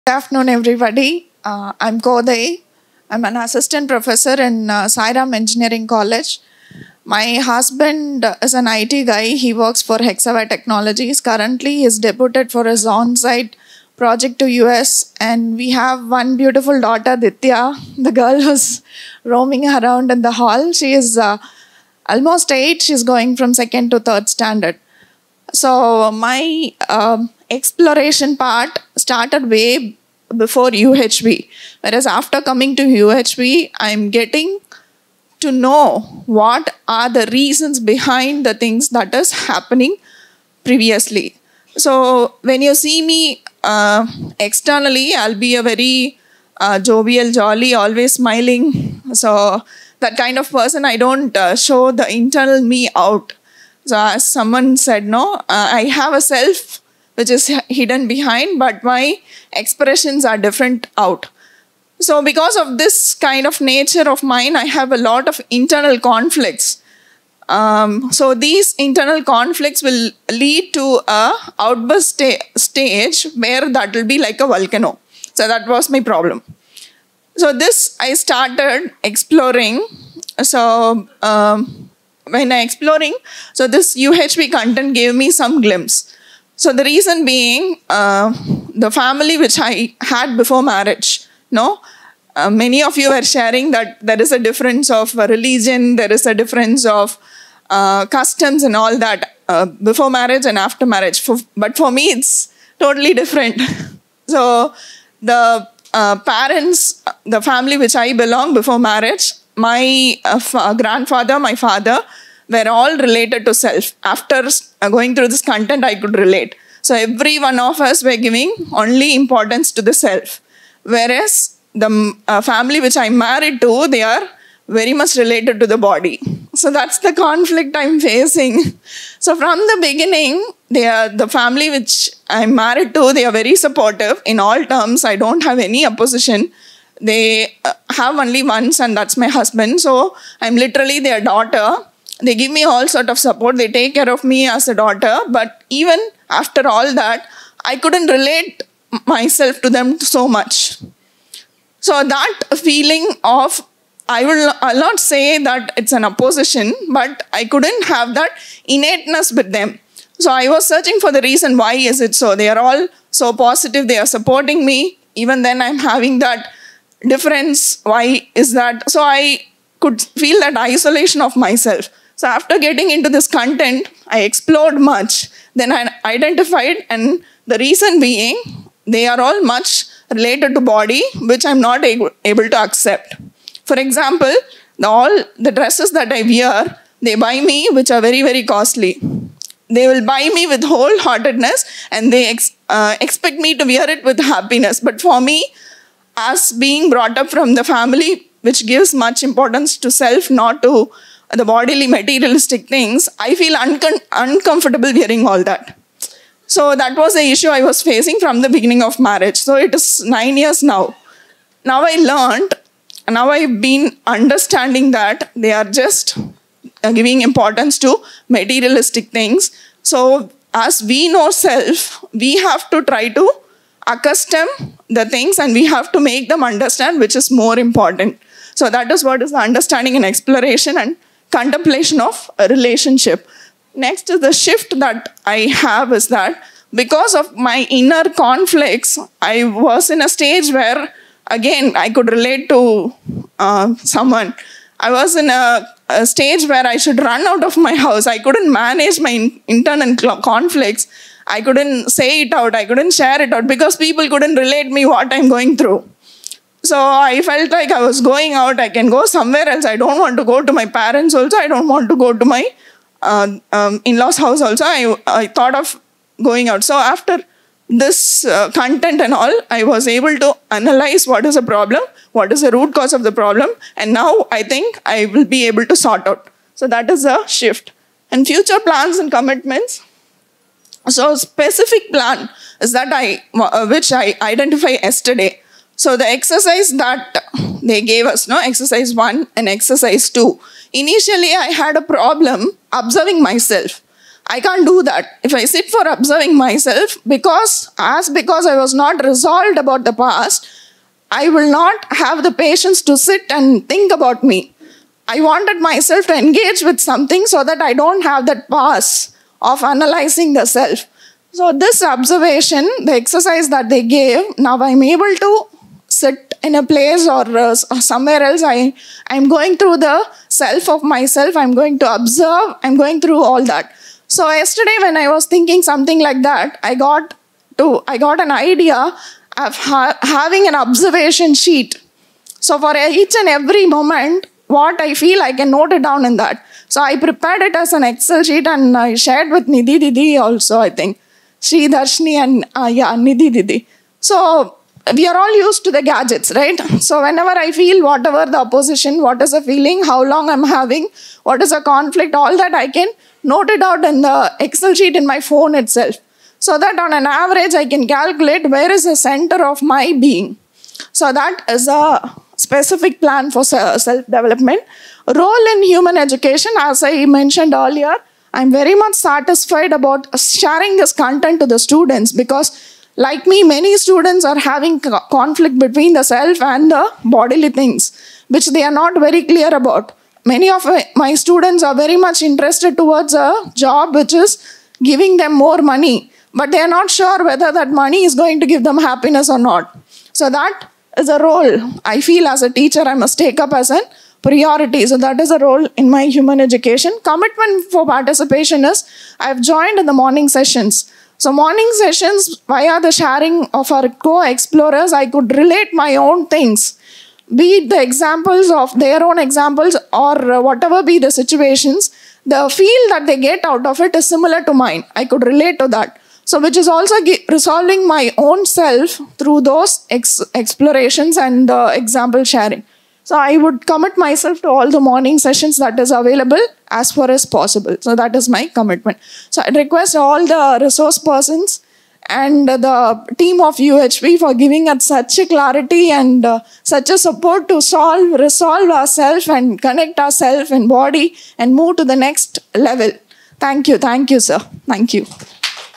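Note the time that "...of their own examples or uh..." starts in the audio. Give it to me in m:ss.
6:48.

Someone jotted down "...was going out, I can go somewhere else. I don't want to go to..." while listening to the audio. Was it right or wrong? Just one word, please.
right.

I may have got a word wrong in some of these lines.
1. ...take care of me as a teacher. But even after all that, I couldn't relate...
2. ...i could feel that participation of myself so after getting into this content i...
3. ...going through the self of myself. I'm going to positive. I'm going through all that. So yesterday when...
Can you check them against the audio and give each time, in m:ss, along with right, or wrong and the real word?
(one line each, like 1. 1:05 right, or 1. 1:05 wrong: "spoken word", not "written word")
1. 2:23 wrong: "daughter", not "teacher"
2. 2:49 wrong: "isolation", not "participation"
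3. 5:19 wrong: "observe", not "positive".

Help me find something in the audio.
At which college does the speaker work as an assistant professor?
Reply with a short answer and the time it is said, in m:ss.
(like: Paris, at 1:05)
Sairam Engineering College, at 0:04.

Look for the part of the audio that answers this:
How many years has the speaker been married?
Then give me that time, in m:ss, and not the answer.
3:30.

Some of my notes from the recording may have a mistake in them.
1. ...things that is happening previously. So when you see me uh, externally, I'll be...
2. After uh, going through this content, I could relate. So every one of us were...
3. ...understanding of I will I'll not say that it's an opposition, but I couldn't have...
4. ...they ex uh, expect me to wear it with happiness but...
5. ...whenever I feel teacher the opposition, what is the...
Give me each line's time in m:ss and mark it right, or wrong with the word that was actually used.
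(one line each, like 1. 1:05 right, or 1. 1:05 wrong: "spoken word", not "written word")
1. 0:38 right
2. 1:54 right
3. 2:32 wrong: "feeling", not "understanding"
4. 3:12 right
5. 5:47 wrong: "whatever", not "teacher".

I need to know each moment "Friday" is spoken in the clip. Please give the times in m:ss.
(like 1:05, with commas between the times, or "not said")
not said.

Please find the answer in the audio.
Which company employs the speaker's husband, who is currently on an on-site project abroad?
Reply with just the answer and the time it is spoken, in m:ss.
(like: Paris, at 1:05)
Hexaware Technologies, at 0:09.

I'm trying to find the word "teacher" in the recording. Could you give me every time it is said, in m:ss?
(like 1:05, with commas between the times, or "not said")
6:32.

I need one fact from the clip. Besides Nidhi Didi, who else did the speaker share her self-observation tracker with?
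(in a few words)
Sri Darshni.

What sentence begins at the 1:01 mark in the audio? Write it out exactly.
So because of this kind of nature of mine, I have a lot of internal conflicts.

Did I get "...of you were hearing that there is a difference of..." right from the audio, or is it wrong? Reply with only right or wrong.
wrong.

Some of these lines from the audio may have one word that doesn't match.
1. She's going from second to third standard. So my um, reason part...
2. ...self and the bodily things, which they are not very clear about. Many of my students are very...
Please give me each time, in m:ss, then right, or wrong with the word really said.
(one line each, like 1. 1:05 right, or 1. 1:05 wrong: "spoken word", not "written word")
1. 0:22 wrong: "exploration", not "reason"
2. 6:16 right.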